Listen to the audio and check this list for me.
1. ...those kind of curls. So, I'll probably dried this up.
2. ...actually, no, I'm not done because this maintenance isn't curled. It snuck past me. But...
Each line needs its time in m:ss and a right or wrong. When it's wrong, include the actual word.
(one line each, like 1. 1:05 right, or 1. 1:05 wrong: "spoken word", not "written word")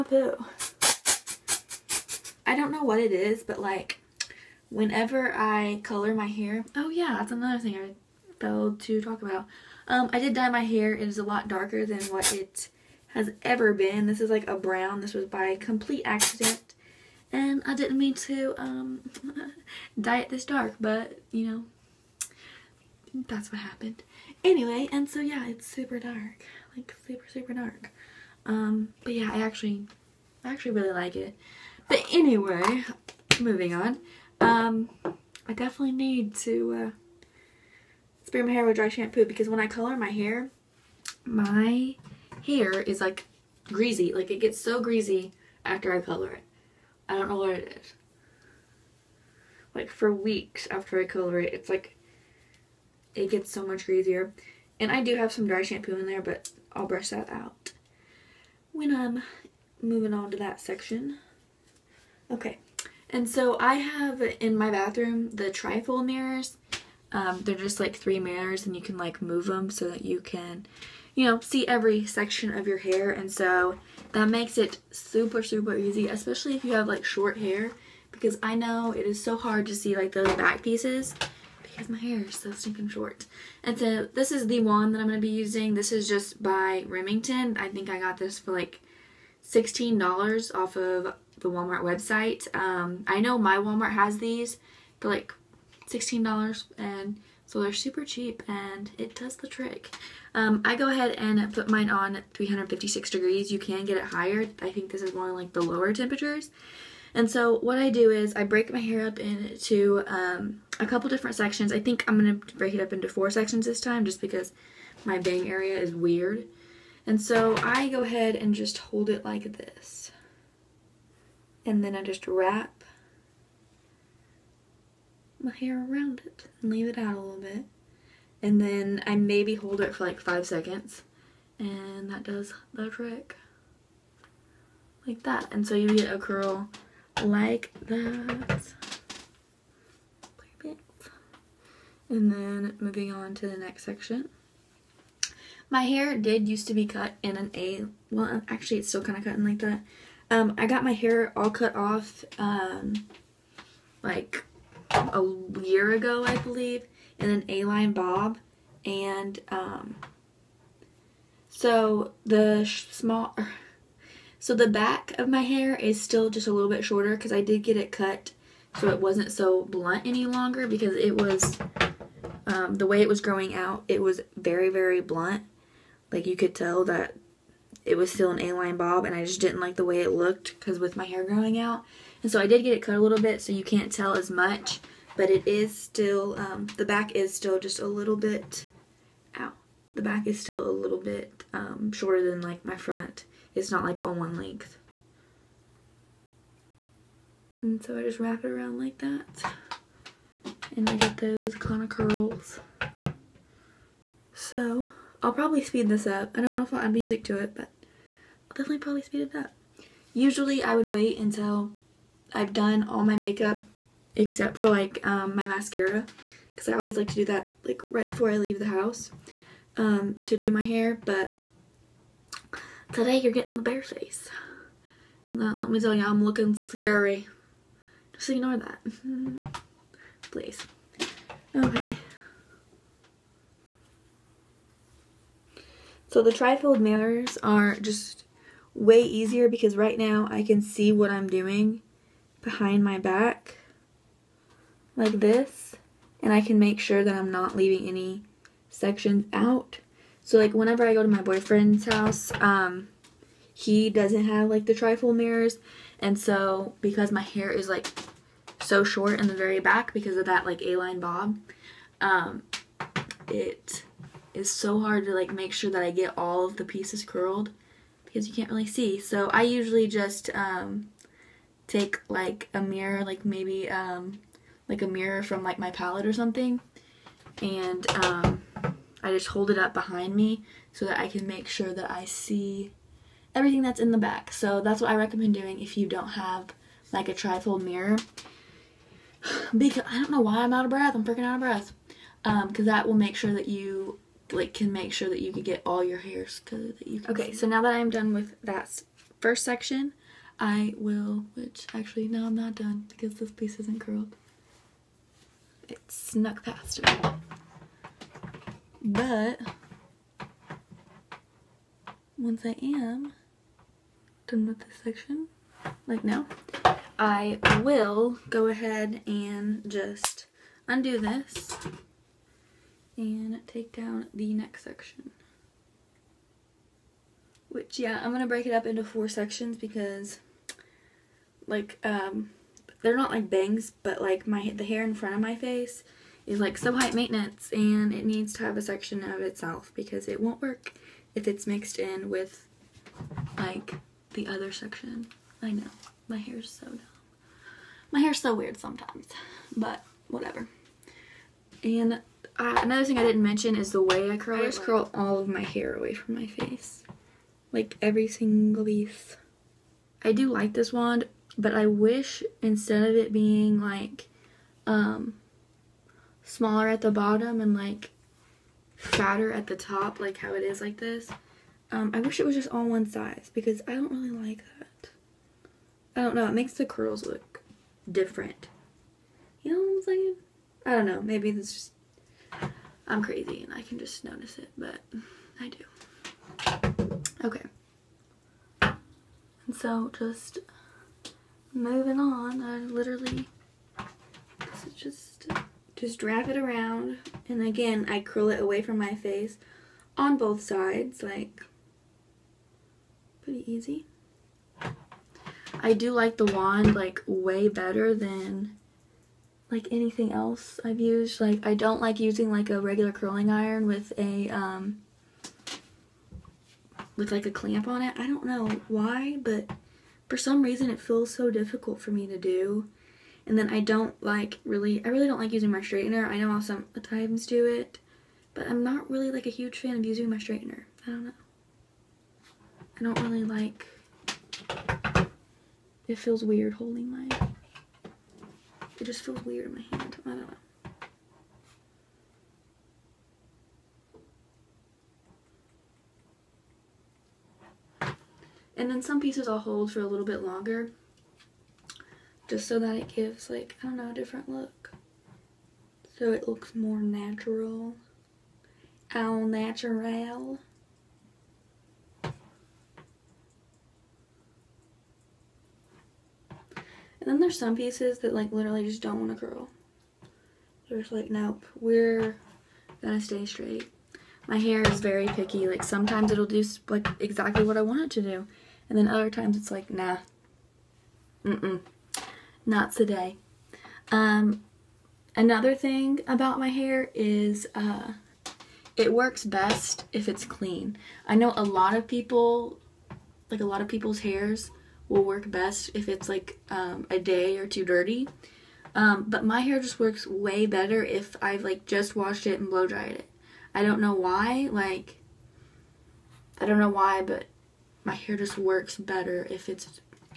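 1. 3:21 wrong: "speed", not "dried"
2. 5:01 wrong: "piece", not "maintenance".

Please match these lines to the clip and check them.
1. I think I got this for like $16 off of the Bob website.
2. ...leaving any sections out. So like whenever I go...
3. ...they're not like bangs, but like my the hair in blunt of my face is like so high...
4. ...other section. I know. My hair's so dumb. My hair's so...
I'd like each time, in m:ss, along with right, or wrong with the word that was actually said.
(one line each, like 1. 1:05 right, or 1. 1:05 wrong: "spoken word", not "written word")
1. 1:27 wrong: "Walmart", not "Bob"
2. 4:07 right
3. 5:32 wrong: "front", not "blunt"
4. 5:44 right.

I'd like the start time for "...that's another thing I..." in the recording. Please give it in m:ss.
0:07.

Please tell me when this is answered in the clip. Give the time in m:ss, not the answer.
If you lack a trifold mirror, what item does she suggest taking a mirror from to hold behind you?
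4:35.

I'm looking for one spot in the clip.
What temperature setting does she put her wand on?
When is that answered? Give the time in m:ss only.
1:42.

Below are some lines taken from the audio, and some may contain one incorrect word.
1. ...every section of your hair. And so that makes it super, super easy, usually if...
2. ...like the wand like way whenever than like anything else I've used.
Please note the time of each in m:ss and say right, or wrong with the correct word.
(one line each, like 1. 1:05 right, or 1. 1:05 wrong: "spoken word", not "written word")
1. 1:11 wrong: "especially", not "usually"
2. 6:45 wrong: "better", not "whenever".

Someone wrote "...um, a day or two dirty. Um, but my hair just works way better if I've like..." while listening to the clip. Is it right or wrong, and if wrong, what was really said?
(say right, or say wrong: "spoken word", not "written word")
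right.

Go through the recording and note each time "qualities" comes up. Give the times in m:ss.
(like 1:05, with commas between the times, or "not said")
not said.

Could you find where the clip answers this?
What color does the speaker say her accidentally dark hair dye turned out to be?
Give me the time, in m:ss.
0:14.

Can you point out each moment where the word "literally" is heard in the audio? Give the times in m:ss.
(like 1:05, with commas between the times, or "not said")
6:32, 7:48.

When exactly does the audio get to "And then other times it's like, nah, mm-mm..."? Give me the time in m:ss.
7:58.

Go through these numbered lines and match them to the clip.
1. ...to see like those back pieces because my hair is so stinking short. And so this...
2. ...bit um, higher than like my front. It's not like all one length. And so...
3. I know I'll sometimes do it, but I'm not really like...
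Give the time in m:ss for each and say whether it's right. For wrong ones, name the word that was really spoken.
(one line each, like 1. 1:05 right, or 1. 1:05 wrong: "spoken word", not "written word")
1. 1:19 right
2. 3:10 wrong: "shorter", not "higher"
3. 7:06 right.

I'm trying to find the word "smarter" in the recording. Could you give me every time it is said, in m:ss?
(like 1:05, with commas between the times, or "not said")
not said.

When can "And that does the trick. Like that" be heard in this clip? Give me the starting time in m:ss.
2:11.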